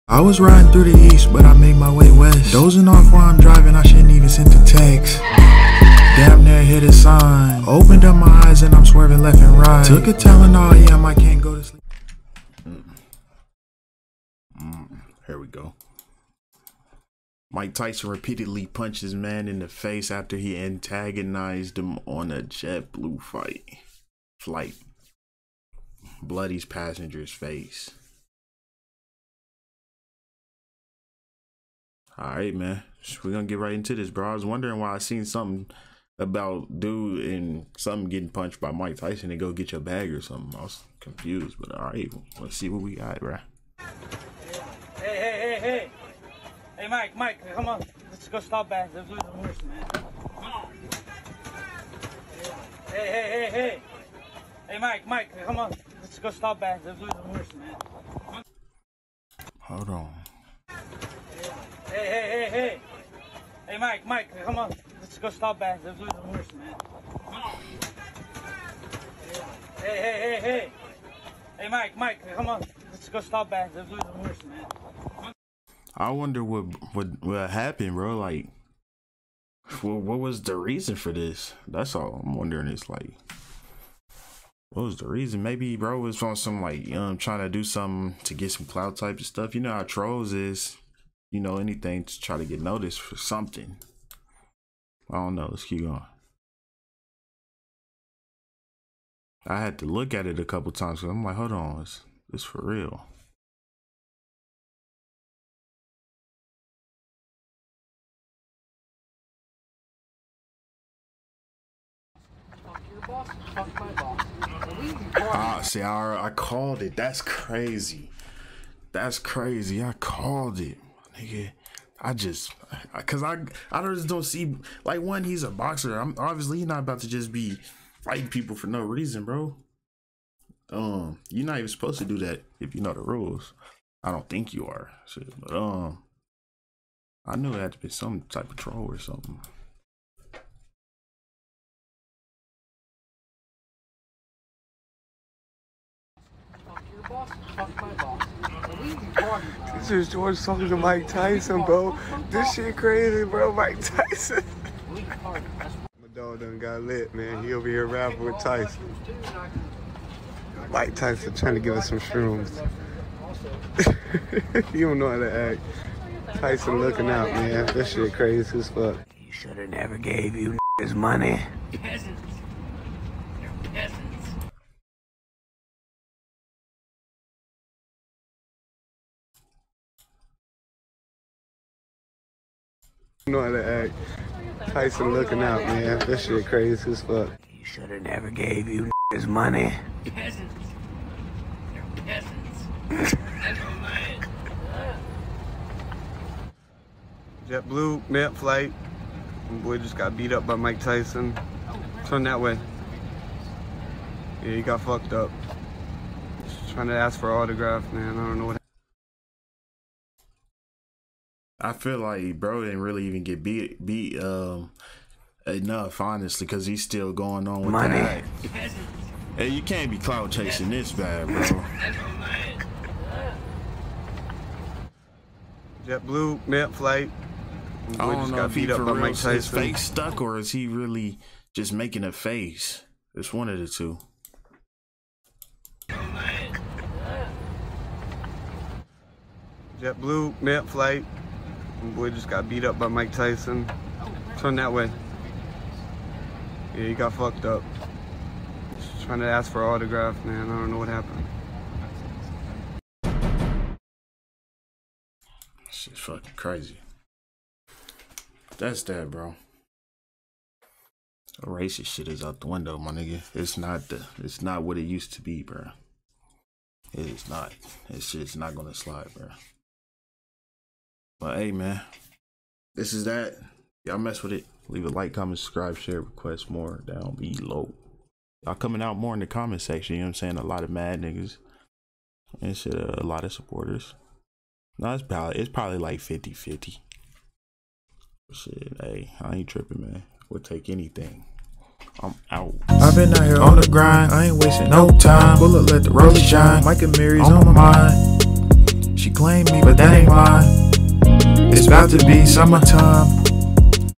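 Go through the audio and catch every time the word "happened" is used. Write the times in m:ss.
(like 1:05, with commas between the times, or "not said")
1:17, 4:10.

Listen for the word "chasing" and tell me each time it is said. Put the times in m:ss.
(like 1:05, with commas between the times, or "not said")
3:40.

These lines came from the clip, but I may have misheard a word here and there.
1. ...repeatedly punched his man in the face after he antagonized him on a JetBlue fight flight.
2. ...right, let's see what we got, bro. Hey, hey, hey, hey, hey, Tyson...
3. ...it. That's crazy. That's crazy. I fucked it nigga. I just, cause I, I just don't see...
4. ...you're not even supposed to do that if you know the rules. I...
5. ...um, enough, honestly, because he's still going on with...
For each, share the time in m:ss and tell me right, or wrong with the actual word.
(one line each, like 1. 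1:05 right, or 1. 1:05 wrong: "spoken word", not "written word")
1. 0:18 right
2. 0:41 wrong: "Mike", not "Tyson"
3. 1:56 wrong: "called", not "fucked"
4. 2:11 right
5. 3:34 right.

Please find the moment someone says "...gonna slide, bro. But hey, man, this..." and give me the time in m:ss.
4:28.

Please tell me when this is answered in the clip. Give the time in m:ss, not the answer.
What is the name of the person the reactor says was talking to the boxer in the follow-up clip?
2:30.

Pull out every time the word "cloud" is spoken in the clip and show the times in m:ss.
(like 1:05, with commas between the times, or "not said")
1:28, 3:39.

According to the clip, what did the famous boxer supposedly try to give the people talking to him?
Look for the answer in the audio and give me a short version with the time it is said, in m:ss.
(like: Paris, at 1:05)
Shrooms, at 2:41.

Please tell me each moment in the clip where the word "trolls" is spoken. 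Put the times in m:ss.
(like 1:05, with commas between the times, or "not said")
1:29, 2:18.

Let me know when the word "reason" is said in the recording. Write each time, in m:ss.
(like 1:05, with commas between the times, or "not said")
1:20, 1:25, 2:08.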